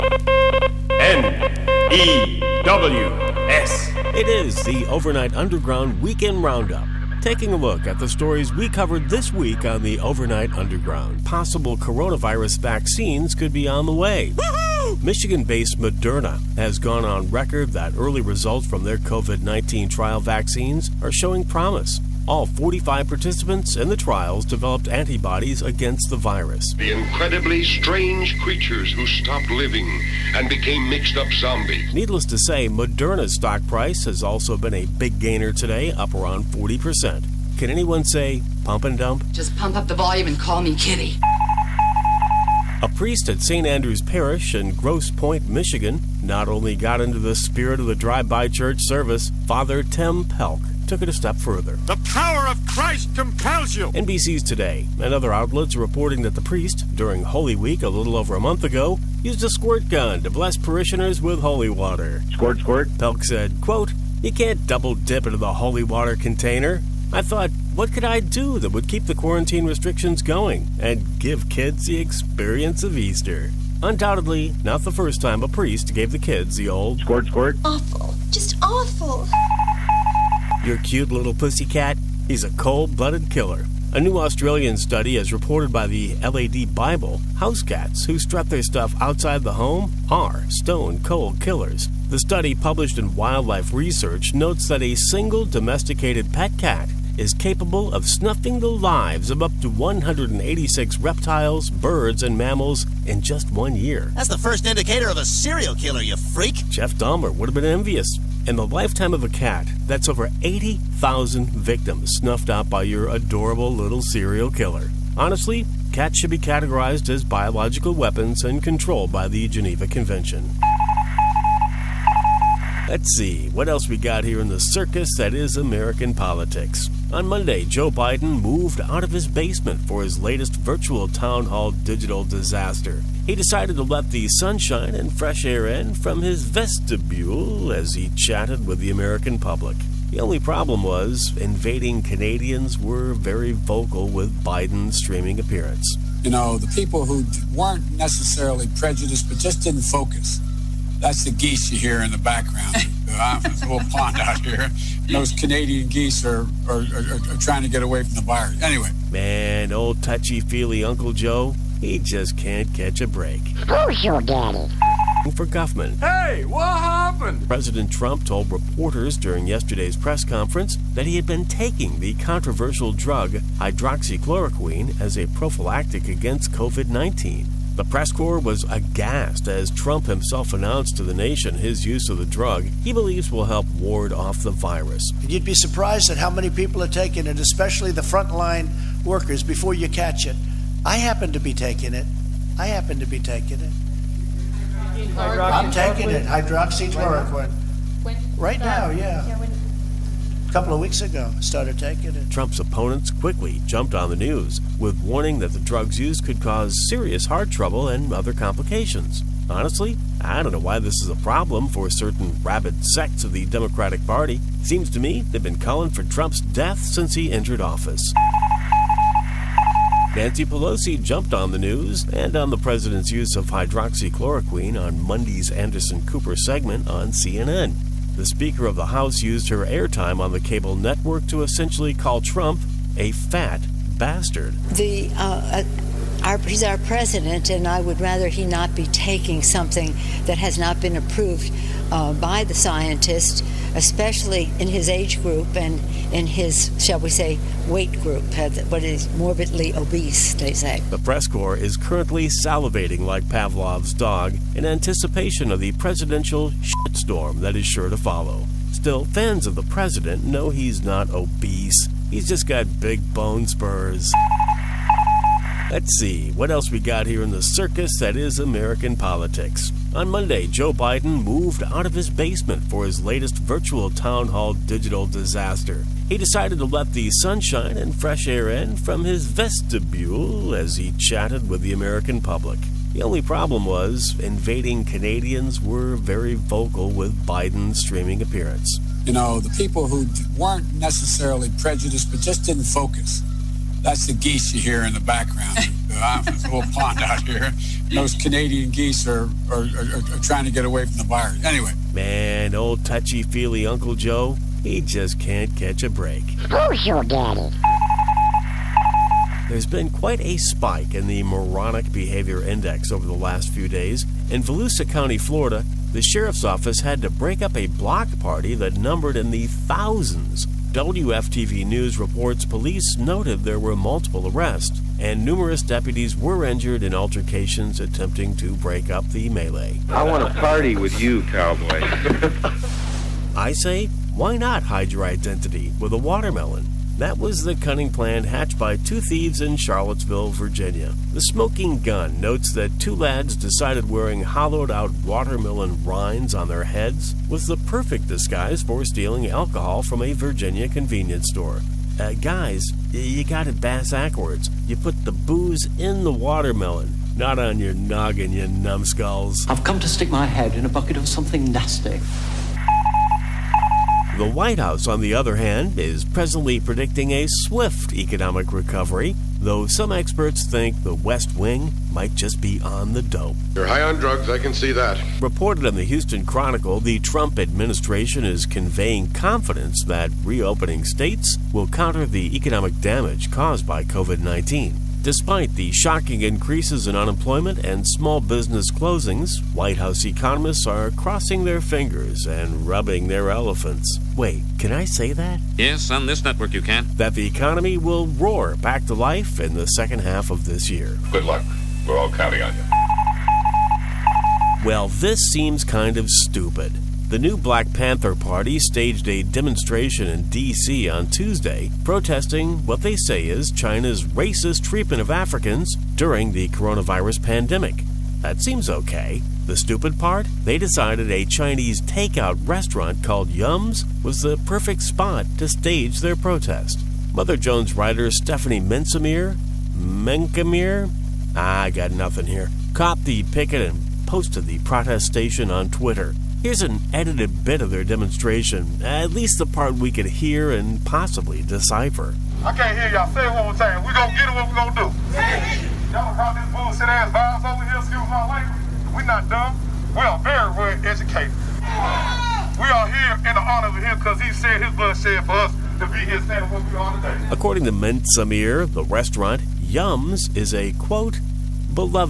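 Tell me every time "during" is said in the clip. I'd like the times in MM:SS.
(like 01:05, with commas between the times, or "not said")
00:56, 02:49, 06:55.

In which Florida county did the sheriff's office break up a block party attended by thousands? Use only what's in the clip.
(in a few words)
Volusia County.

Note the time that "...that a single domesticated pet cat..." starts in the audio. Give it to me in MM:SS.
01:34.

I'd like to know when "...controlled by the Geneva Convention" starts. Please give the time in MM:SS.
01:58.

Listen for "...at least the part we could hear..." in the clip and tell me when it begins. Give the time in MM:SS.
07:18.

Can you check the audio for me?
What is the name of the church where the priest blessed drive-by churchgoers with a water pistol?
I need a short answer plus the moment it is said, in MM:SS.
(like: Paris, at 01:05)
St. Andrew's Parish, at 00:43.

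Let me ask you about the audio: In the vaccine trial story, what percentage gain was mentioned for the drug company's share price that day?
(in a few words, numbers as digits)
40%.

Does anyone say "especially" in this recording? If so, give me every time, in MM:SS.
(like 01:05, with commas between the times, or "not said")
03:07, 04:03.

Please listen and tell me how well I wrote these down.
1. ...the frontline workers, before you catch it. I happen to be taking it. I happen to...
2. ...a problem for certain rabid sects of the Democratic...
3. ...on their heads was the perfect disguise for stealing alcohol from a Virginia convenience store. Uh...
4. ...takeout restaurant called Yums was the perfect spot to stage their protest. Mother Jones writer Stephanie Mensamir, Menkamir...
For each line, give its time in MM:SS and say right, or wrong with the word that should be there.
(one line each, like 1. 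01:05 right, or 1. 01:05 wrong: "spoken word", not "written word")
1. 03:07 right
2. 03:31 right
3. 05:46 right
4. 07:01 right.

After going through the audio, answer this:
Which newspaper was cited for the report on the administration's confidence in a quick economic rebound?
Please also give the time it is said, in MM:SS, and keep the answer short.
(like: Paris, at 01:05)
Houston Chronicle, at 06:15.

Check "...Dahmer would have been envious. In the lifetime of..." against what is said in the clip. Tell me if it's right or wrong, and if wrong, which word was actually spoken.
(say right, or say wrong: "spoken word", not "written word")
right.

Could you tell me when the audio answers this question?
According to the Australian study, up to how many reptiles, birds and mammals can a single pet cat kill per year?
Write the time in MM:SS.
01:39.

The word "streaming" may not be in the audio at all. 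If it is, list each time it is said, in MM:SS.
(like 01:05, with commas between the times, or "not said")
02:24, 04:47.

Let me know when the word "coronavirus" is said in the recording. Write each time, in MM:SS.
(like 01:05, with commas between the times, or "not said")
00:11, 06:56.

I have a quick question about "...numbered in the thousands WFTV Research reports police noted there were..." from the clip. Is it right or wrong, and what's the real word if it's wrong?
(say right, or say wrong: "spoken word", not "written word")
wrong: "News", not "Research".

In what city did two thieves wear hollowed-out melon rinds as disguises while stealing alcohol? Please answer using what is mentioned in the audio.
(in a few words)
Charlottesville.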